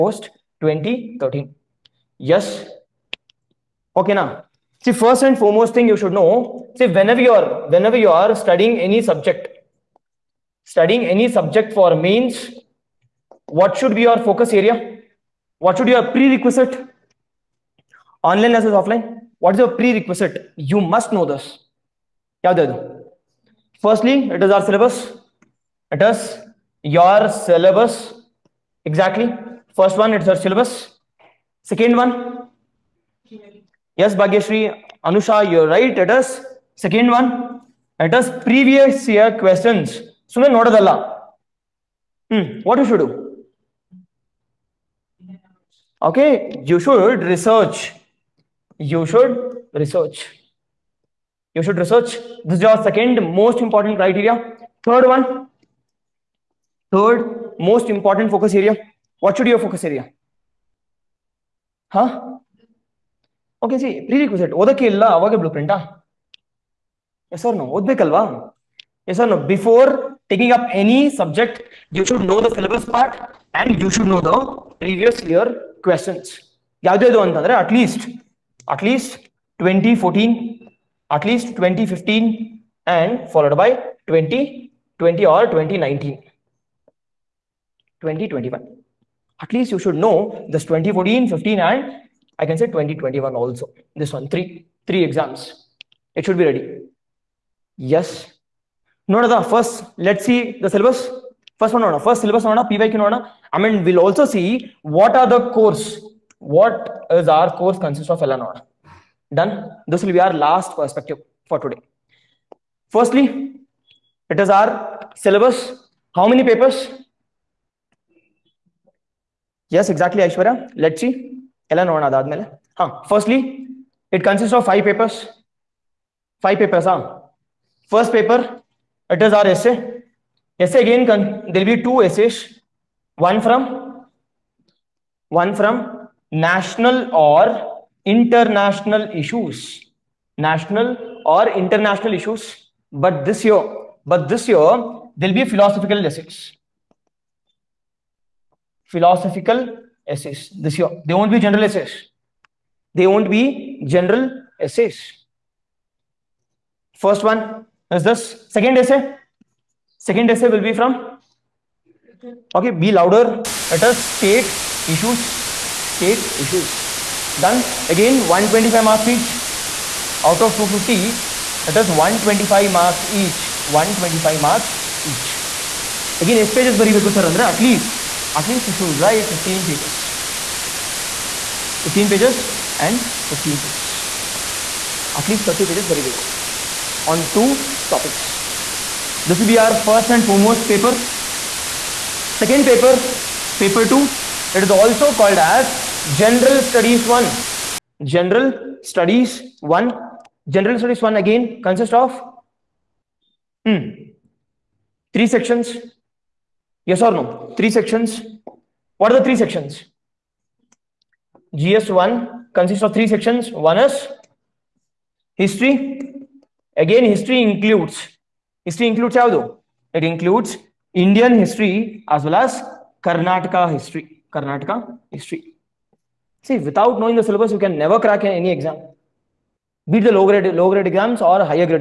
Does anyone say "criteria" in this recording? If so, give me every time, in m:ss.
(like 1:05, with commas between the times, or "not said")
0:54.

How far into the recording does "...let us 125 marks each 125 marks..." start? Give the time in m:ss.
2:51.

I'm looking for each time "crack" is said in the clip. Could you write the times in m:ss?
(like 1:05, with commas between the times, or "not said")
3:48.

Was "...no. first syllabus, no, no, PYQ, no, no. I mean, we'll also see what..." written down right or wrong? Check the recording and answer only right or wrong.
right.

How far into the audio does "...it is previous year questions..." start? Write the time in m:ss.
0:38.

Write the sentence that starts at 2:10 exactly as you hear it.
Essay again, there will be two essays.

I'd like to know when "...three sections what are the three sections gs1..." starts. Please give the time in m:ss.
3:27.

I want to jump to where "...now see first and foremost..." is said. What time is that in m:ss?
0:04.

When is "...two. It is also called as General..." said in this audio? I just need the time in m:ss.
3:13.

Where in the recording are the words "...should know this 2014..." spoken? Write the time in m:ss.
1:29.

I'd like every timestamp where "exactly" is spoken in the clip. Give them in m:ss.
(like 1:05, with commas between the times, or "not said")
0:28, 1:59.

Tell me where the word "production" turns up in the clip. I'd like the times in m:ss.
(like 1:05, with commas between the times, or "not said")
not said.